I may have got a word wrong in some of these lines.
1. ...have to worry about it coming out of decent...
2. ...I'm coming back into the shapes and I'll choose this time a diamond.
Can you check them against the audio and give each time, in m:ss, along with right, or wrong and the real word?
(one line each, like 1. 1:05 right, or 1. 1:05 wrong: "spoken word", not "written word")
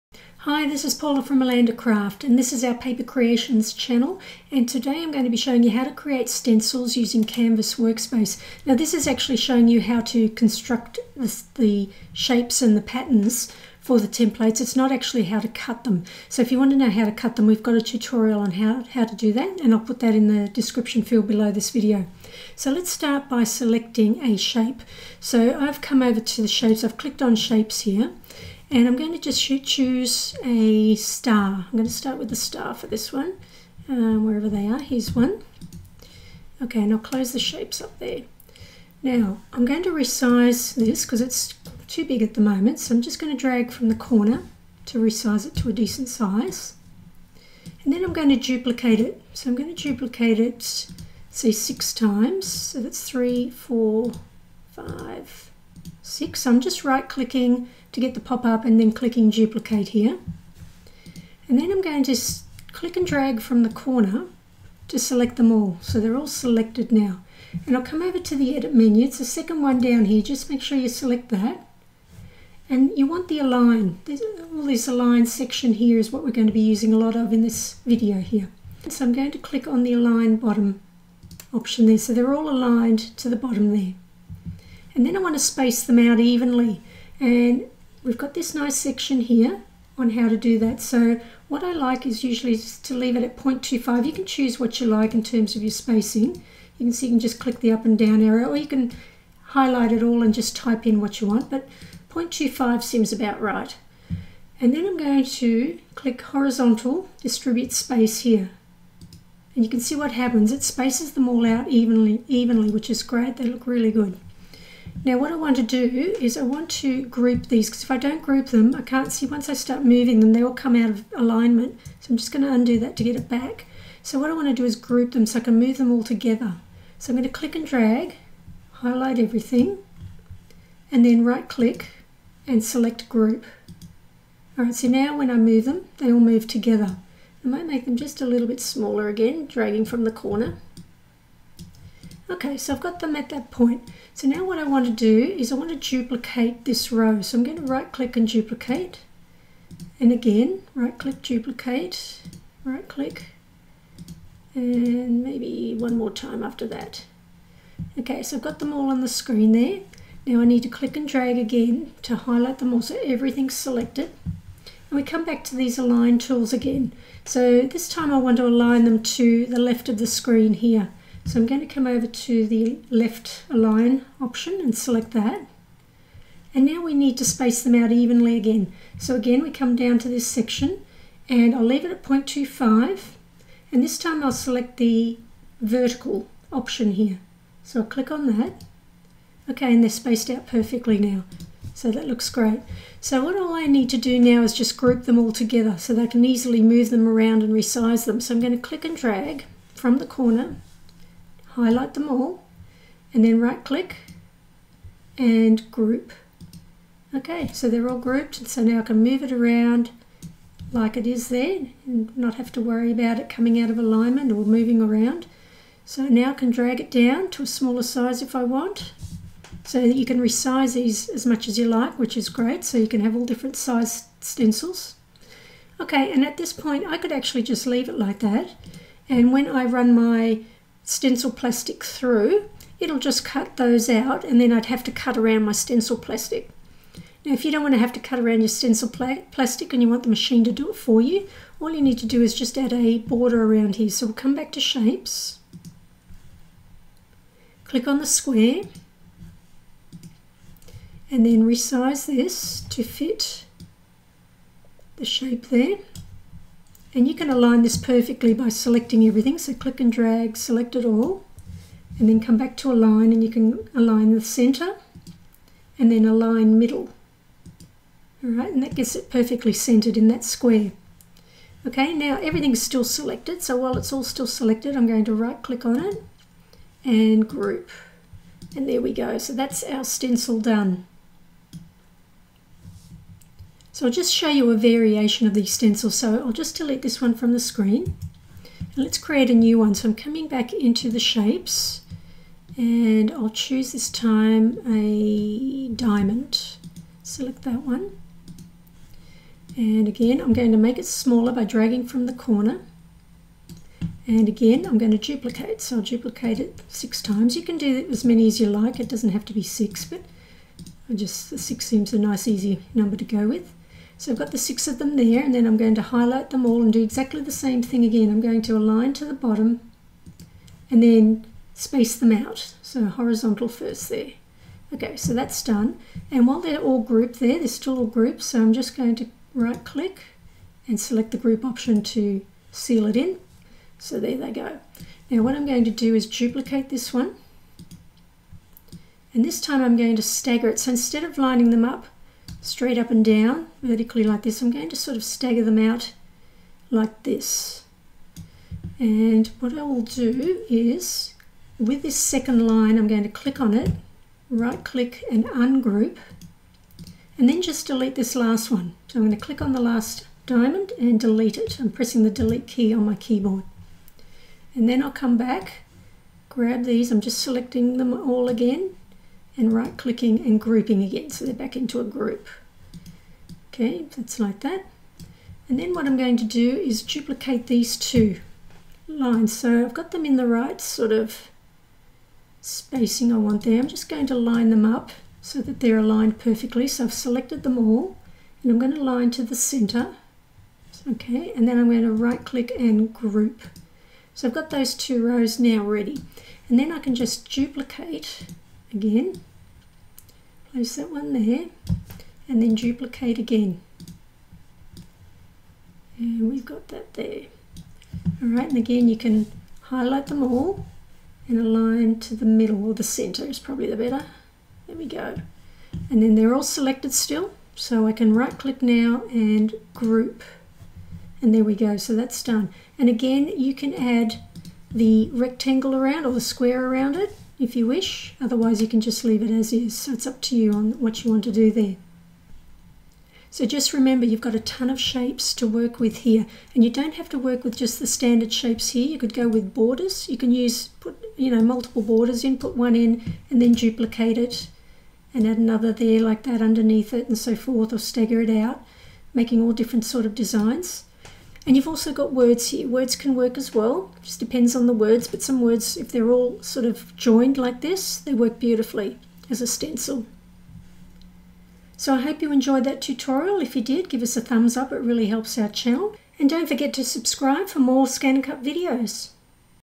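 1. 3:32 wrong: "alignment", not "decent"
2. 4:49 right.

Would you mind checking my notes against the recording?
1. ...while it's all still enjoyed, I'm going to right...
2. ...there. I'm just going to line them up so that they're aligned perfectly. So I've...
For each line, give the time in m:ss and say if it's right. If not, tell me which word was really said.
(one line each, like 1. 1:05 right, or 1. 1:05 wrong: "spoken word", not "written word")
1. 4:33 wrong: "selected", not "enjoyed"
2. 6:23 right.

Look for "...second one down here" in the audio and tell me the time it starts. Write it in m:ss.
1:09.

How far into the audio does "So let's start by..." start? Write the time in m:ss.
0:22.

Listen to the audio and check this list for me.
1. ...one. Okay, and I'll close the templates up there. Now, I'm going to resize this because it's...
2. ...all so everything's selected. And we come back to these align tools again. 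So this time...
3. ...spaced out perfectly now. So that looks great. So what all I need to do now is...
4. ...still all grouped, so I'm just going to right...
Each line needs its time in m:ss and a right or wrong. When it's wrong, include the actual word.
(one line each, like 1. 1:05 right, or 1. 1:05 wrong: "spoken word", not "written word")
1. 0:35 wrong: "shapes", not "templates"
2. 2:42 right
3. 3:09 right
4. 5:27 right.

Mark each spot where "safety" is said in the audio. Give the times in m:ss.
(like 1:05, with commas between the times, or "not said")
not said.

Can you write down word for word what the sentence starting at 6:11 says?
So they're back into a group.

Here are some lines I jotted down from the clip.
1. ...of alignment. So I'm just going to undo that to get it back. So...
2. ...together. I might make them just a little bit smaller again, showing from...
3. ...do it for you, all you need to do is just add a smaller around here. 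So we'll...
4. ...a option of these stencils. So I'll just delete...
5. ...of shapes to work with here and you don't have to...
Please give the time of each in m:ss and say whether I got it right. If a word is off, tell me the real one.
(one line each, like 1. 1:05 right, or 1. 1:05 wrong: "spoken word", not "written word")
1. 2:00 right
2. 2:16 wrong: "dragging", not "showing"
3. 4:00 wrong: "border", not "smaller"
4. 4:44 wrong: "variation", not "option"
5. 7:14 right.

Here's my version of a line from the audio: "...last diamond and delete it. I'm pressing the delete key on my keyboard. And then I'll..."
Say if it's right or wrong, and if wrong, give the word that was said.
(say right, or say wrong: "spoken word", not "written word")
right.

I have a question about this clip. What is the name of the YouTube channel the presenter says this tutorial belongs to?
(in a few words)
Paper Creations.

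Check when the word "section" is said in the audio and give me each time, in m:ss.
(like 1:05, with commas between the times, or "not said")
1:15, 1:28, 3:00.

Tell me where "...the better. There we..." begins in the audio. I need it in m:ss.
6:53.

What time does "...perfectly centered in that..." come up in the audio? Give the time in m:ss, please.
4:29.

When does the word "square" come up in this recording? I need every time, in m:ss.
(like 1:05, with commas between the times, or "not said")
4:08, 4:30, 7:06.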